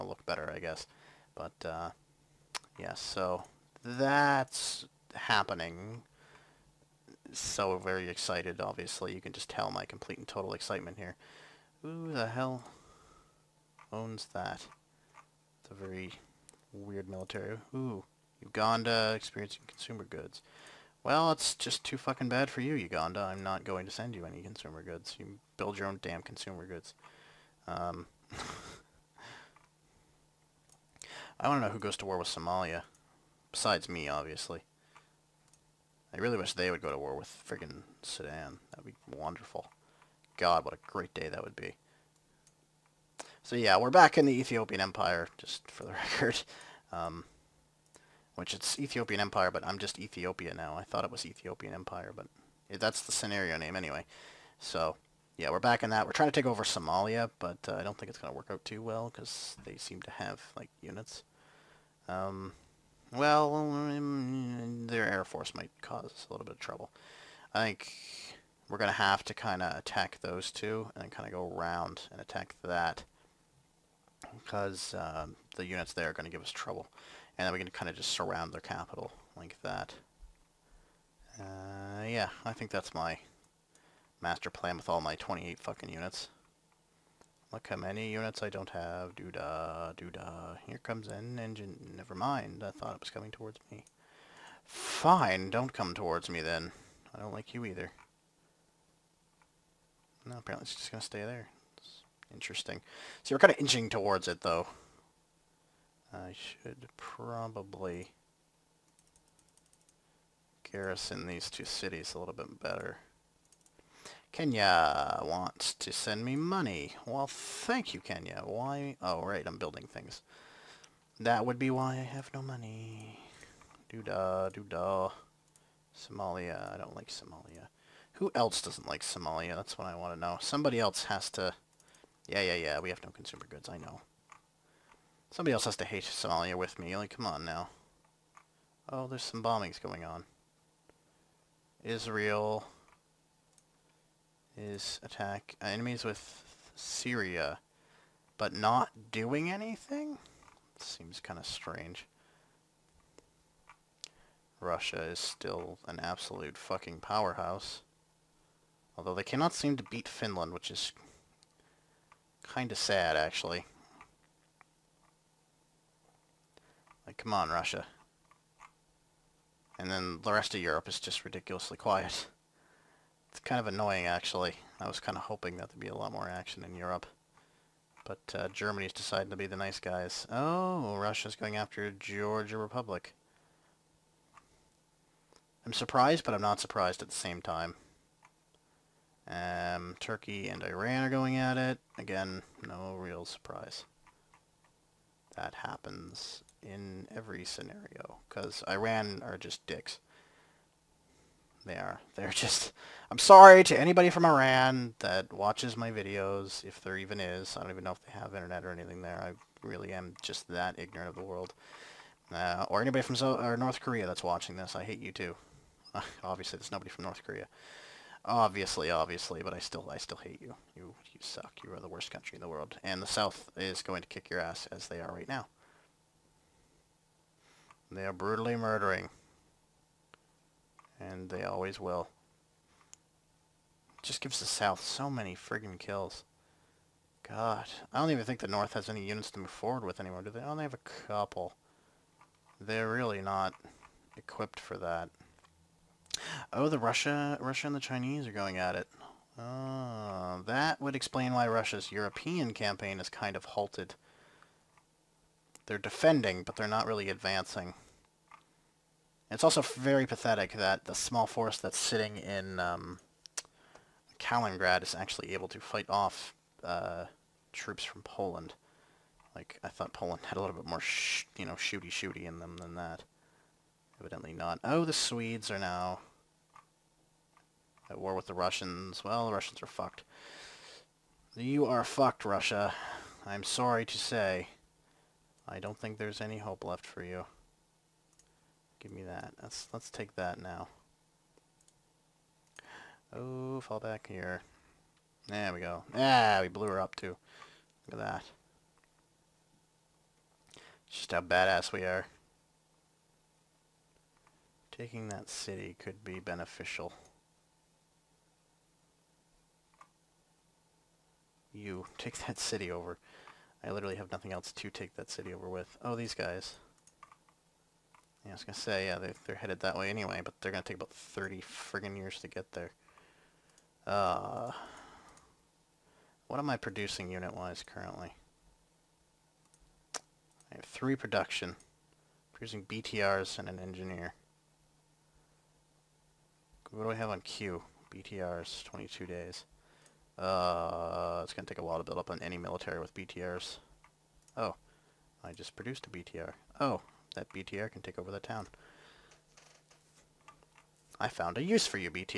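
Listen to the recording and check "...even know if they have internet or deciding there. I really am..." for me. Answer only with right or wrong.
wrong.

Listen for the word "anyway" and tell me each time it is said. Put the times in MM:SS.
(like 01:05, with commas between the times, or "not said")
00:53, 05:19.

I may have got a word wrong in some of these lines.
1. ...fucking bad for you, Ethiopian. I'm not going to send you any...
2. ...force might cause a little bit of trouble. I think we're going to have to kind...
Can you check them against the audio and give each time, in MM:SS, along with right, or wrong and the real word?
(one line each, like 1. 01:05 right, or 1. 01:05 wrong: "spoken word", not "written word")
1. 00:21 wrong: "Uganda", not "Ethiopian"
2. 01:05 right.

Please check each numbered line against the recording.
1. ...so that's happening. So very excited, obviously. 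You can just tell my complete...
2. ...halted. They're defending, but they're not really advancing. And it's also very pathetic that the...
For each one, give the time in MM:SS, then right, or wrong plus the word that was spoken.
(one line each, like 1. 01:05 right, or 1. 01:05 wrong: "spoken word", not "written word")
1. 00:02 right
2. 04:13 right.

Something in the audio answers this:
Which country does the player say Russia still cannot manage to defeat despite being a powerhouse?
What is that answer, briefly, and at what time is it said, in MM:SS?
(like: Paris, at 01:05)
Finland, at 02:40.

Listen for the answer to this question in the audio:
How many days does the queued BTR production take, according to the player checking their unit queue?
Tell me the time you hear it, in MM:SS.
05:38.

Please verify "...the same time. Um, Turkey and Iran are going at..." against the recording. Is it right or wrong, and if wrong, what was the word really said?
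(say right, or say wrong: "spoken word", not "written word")
right.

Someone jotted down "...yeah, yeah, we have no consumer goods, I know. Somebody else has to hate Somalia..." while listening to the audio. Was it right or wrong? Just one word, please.
right.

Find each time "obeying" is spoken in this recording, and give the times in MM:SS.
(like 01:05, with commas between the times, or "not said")
not said.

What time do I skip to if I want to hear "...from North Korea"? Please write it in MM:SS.
03:36.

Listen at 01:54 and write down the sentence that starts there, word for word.
Kenya wants to send me money.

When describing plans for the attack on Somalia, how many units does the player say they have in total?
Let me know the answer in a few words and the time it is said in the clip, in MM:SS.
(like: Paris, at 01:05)
28, at 01:25.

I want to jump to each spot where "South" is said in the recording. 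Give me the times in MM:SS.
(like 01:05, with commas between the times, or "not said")
03:43, 03:54.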